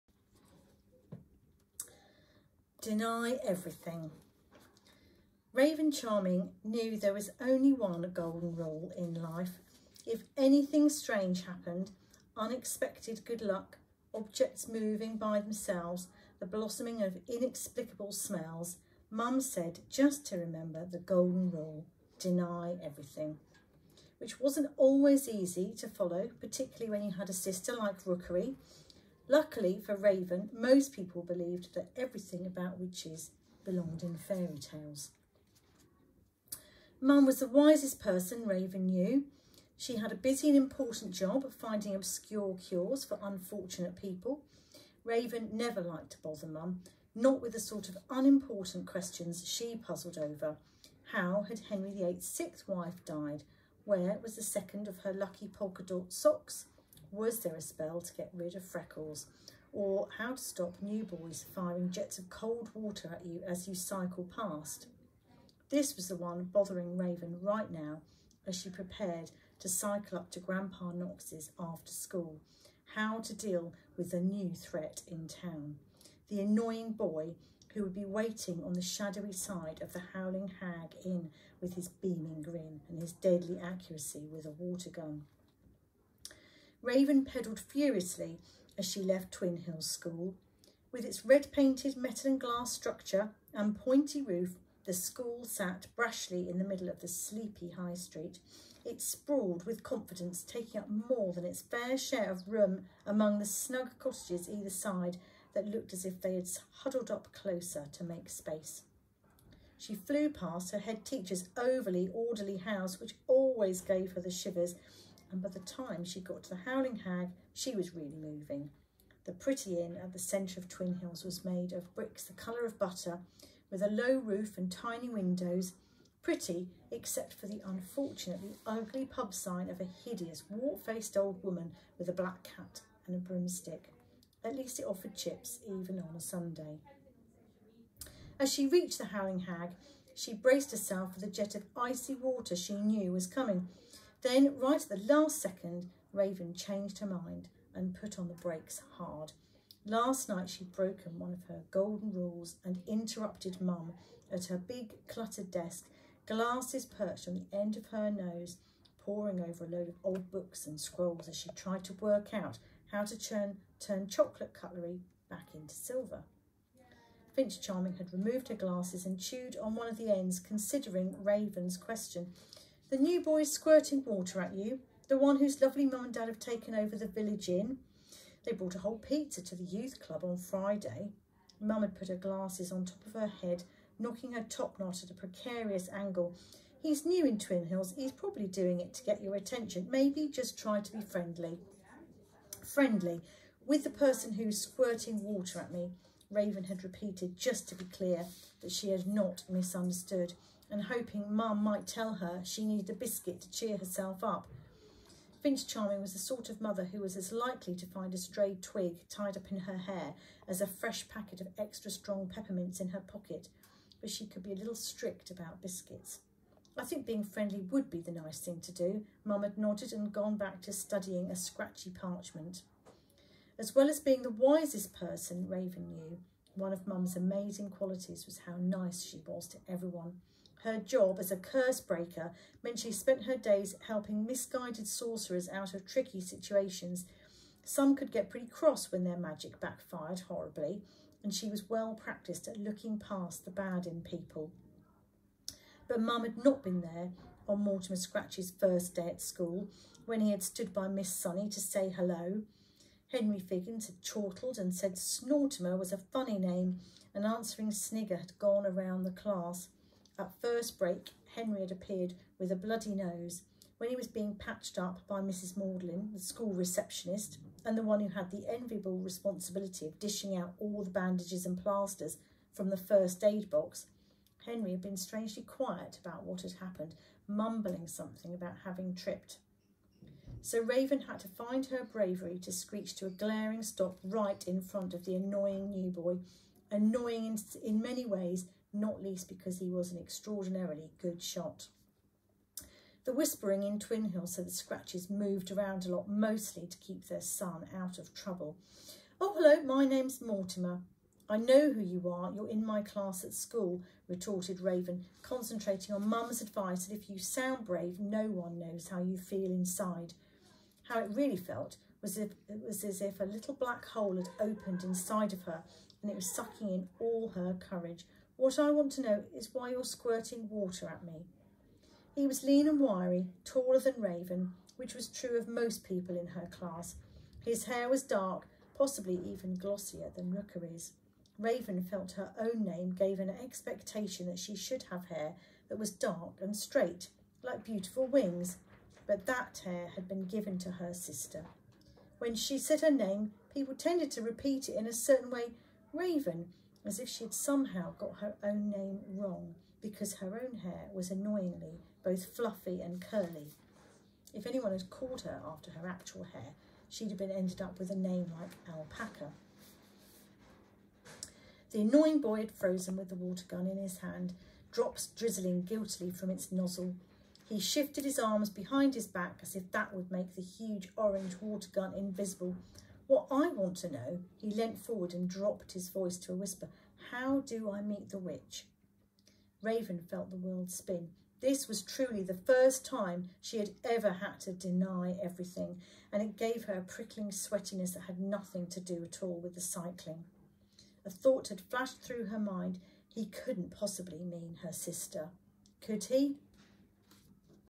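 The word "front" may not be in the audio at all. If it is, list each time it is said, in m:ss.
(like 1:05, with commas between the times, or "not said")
4:44.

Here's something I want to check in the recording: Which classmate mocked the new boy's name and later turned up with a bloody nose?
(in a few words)
Henry Figgins.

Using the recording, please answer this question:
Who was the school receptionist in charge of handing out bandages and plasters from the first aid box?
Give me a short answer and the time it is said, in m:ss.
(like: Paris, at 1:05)
Mrs Maudlin, at 4:25.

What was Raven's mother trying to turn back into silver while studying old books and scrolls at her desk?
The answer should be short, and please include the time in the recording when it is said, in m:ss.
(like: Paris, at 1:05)
chocolate cutlery, at 2:44.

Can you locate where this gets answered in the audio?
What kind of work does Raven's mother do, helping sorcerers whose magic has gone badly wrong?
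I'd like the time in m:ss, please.
3:51.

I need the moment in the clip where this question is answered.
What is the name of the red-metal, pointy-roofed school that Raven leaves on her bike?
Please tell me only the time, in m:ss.
1:29.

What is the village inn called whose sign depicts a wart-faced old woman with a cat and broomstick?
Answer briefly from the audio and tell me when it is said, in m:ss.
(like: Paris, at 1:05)
Howling Hag Inn, at 1:20.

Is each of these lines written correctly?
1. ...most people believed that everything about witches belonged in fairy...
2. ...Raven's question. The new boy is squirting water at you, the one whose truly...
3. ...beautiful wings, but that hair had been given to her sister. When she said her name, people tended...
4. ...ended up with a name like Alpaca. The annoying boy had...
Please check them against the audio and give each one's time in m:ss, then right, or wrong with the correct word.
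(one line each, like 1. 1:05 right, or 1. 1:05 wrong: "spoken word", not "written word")
1. 0:30 right
2. 2:51 wrong: "lovely", not "truly"
3. 5:37 right
4. 5:57 right.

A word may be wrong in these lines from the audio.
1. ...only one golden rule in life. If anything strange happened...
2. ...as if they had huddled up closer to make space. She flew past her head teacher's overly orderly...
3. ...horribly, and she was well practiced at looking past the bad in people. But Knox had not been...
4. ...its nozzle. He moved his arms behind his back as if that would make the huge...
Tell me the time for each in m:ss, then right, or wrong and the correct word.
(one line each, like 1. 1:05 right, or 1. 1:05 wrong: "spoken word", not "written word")
1. 0:07 right
2. 1:45 right
3. 4:00 wrong: "Mum", not "Knox"
4. 6:06 wrong: "shifted", not "moved".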